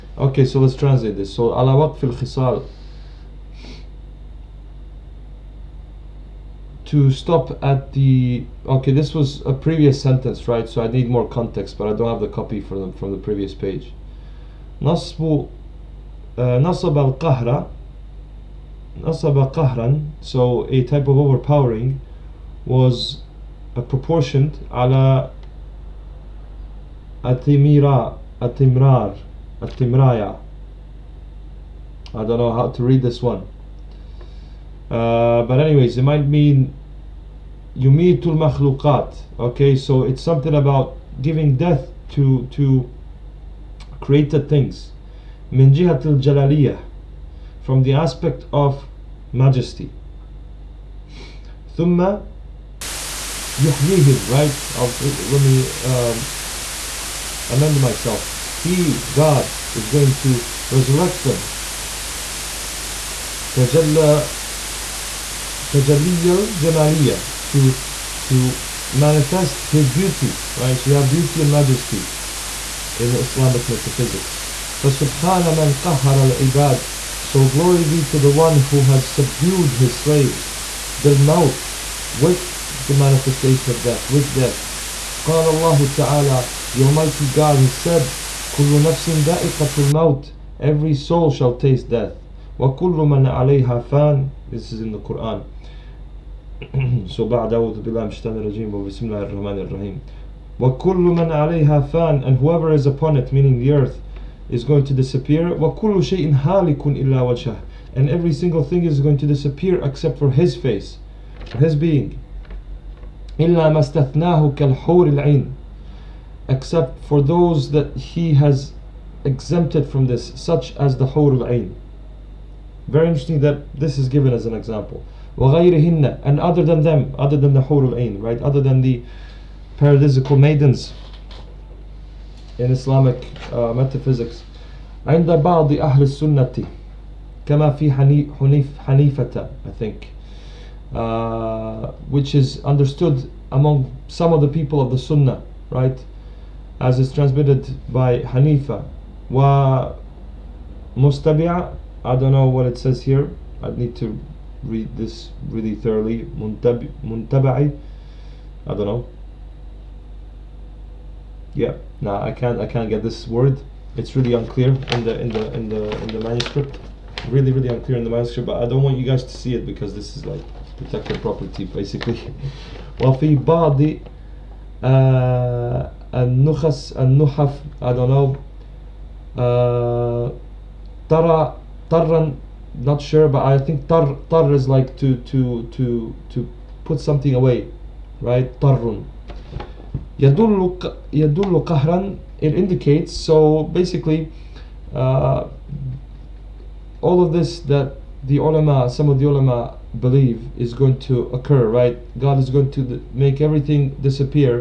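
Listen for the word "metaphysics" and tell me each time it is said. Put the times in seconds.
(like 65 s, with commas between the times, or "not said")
73 s, 133 s.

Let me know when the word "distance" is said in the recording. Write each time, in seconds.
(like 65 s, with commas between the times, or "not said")
not said.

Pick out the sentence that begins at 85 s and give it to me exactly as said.
قال الله تعالى the Almighty God has said, كل نفس دائقة الموت Every soul shall taste death.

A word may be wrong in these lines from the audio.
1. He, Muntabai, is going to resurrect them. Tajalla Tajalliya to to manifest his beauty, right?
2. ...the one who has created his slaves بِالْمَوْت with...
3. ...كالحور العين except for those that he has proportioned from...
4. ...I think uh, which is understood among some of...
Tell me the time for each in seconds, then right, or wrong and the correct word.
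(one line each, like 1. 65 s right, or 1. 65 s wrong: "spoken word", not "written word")
1. 58 s wrong: "God", not "Muntabai"
2. 78 s wrong: "subdued", not "created"
3. 114 s wrong: "exempted", not "proportioned"
4. 139 s right.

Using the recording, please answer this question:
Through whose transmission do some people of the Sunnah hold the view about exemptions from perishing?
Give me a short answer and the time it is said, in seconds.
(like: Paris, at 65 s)
Hanifa, at 148 s.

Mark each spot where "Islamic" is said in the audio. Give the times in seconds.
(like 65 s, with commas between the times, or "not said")
73 s, 132 s.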